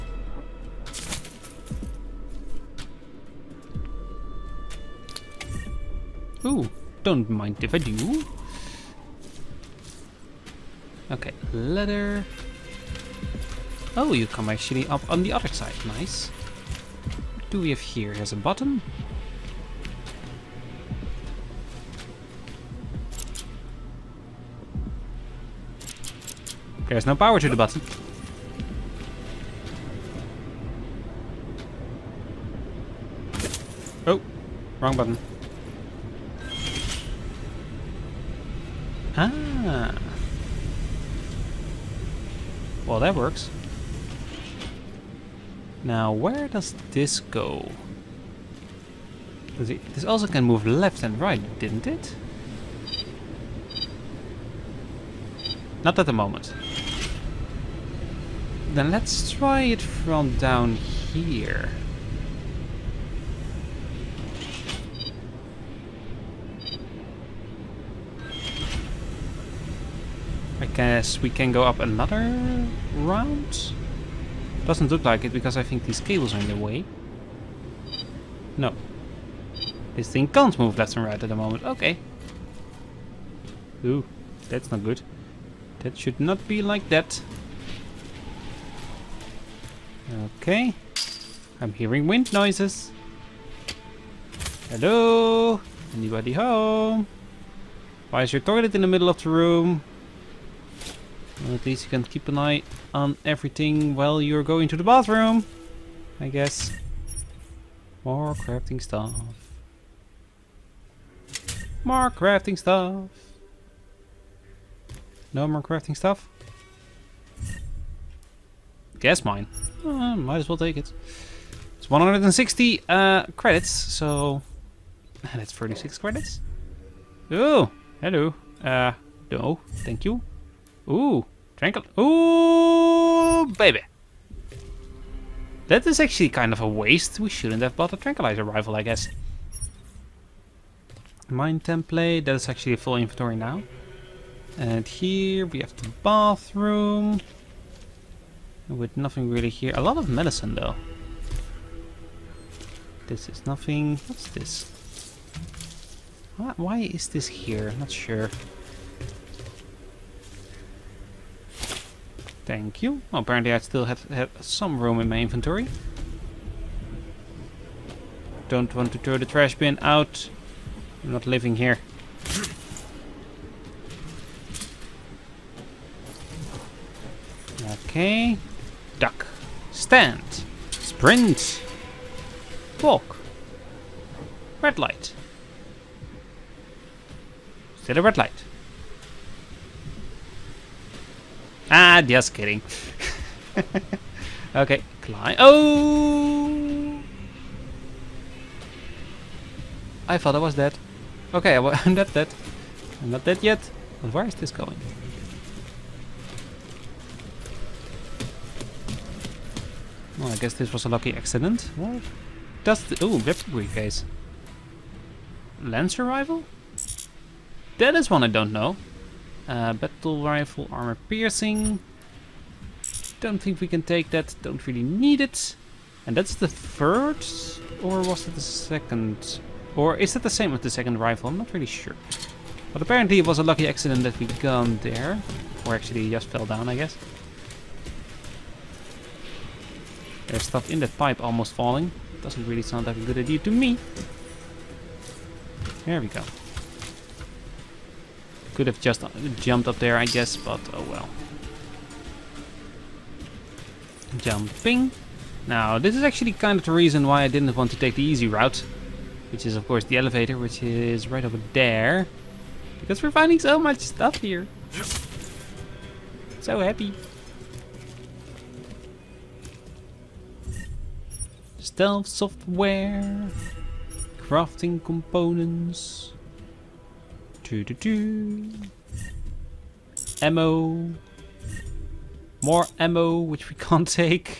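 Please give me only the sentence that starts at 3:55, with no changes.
Or actually just fell down, I guess.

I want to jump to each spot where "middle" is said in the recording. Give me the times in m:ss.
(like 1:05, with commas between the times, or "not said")
1:38.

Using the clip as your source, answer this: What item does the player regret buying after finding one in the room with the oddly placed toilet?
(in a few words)
tranquilizer rifle.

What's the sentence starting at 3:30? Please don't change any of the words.
Well, I guess this was a lucky accident.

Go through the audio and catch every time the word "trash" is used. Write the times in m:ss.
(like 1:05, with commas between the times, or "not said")
2:49.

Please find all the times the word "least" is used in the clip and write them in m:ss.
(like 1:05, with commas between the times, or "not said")
1:41.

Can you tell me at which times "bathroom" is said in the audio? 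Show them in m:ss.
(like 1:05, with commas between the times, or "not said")
1:44, 2:26.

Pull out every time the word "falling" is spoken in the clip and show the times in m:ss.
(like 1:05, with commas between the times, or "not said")
4:01.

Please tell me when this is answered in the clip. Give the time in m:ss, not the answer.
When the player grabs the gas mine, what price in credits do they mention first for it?
2:01.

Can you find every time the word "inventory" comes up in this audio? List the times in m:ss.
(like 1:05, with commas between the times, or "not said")
2:22, 2:45.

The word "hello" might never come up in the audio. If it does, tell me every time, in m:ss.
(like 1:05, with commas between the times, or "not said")
1:34, 2:07.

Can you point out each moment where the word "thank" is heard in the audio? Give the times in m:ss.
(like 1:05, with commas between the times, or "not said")
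2:09, 2:42.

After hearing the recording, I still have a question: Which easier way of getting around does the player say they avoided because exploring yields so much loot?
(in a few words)
the elevator.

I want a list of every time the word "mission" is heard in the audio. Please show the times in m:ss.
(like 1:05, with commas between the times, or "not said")
not said.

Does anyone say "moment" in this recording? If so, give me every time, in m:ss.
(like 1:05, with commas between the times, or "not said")
0:56, 1:21.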